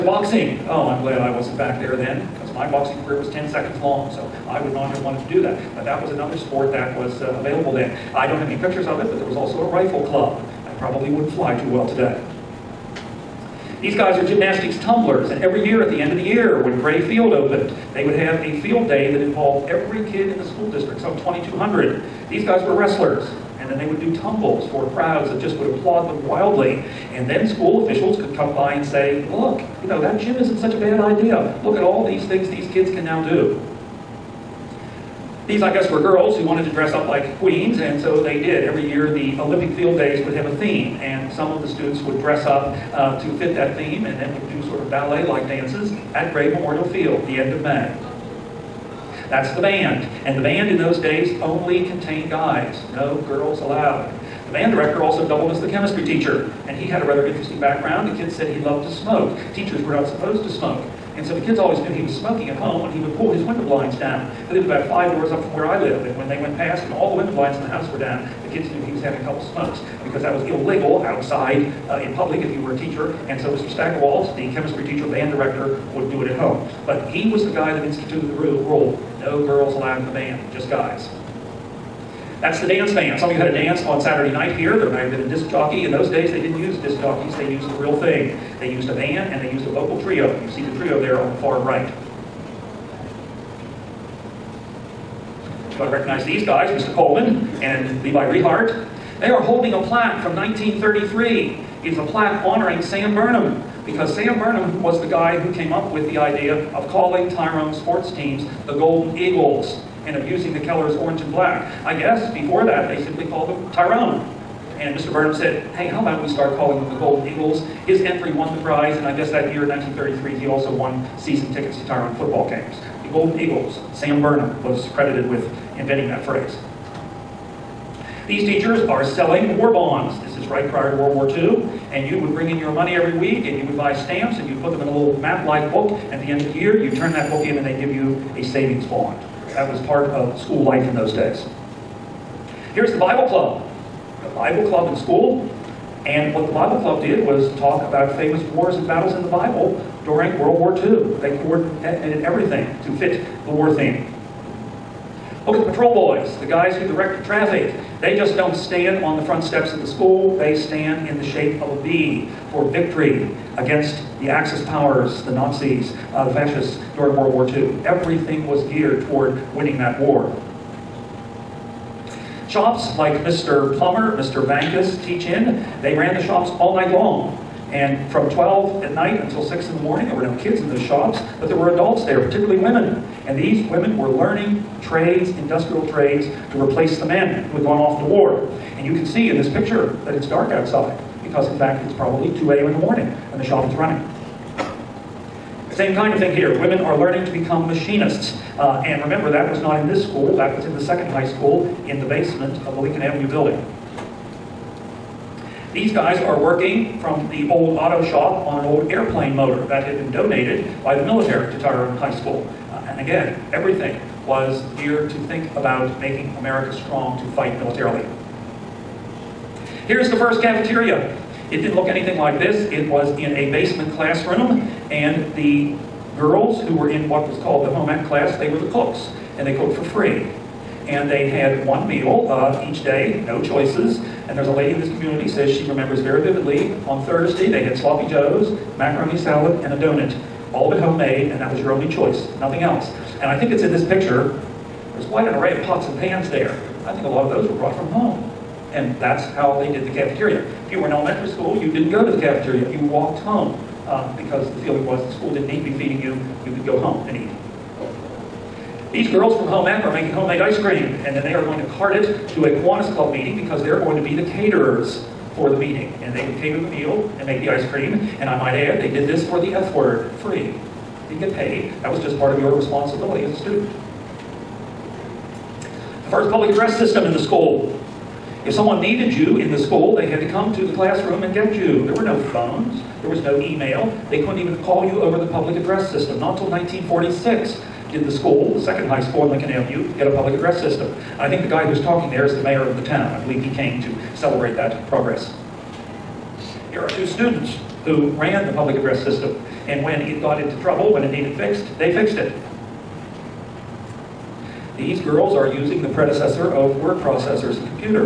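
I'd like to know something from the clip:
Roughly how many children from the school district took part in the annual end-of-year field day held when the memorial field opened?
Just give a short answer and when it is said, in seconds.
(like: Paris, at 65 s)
2,200, at 21 s.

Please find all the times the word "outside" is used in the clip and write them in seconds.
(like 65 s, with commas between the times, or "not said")
71 s, 190 s.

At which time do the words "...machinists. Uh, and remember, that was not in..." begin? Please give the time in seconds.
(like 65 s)
197 s.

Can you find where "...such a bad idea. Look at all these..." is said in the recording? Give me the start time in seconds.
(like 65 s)
30 s.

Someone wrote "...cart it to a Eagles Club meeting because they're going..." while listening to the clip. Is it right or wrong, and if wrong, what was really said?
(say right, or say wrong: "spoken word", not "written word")
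wrong: "Kiwanis", not "Eagles".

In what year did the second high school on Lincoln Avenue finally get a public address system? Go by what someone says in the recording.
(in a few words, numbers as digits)
1946.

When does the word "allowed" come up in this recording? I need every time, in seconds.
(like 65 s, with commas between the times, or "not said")
53 s, 79 s.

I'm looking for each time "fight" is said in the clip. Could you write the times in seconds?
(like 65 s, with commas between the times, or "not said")
217 s.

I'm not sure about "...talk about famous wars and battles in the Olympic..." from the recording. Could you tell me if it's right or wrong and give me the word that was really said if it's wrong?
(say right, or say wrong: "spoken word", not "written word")
wrong: "Bible", not "Olympic".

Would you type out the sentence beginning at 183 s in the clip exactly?
And these women were learning trades, industrial trades, to replace the men who had gone off to war.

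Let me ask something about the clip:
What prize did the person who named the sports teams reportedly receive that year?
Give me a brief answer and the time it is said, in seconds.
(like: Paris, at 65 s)
Season tickets, at 121 s.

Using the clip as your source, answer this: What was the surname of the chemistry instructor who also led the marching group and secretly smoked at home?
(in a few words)
Stackerwald.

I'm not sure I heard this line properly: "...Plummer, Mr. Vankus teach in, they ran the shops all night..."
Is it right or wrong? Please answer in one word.
right.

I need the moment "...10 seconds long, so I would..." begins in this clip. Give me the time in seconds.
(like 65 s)
3 s.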